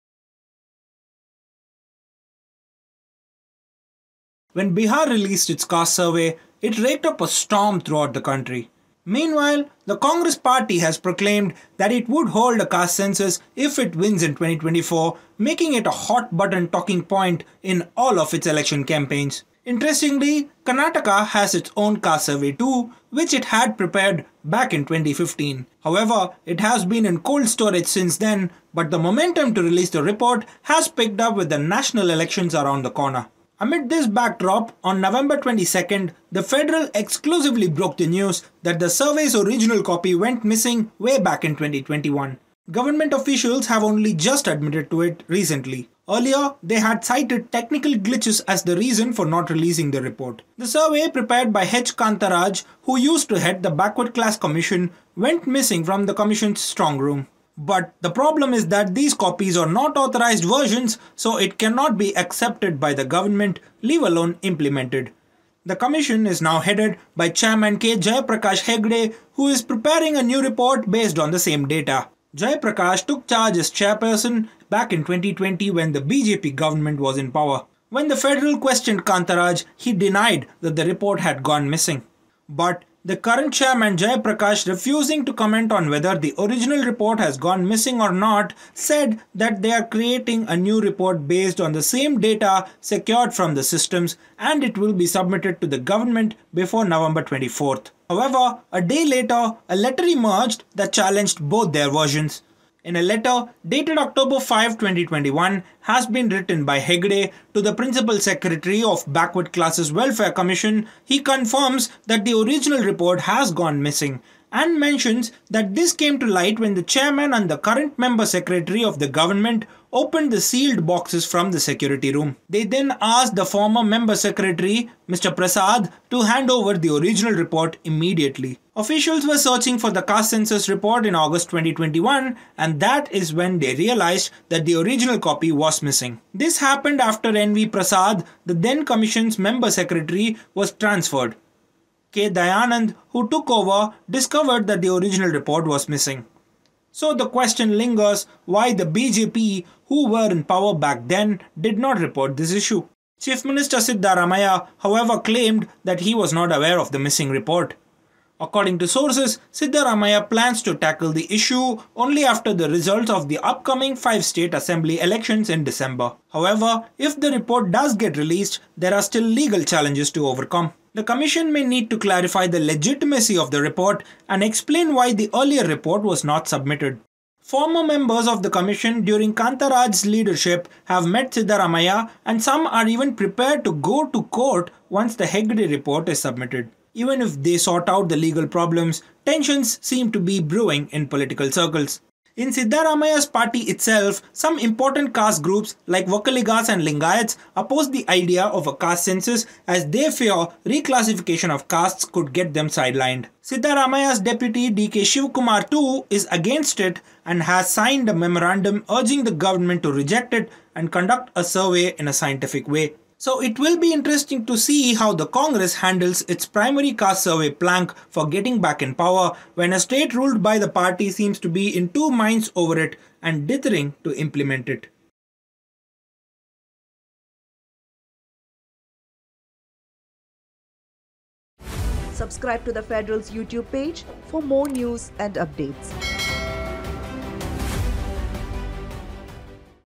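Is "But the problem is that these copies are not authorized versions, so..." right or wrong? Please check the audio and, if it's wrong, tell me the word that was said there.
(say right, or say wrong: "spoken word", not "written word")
right.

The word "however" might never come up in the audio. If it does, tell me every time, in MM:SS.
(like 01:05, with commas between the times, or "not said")
00:25, 01:38, 02:34, 02:46.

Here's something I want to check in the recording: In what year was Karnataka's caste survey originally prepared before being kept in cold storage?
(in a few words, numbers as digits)
2015.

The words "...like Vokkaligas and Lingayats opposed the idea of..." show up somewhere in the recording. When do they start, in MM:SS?
03:15.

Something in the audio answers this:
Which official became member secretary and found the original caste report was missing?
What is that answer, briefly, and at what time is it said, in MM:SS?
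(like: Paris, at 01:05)
K. Dayanand, at 02:22.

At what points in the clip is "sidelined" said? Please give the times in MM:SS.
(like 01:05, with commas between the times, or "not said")
03:22.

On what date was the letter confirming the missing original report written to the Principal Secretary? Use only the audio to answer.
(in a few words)
October 5, 2021.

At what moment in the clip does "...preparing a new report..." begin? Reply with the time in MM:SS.
01:09.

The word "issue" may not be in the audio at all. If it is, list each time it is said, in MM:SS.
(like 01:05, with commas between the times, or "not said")
02:32, 02:41.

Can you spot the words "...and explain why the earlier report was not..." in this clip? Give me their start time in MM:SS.
02:54.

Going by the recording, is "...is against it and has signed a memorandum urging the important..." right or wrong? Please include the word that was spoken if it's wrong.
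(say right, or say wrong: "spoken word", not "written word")
wrong: "government", not "important".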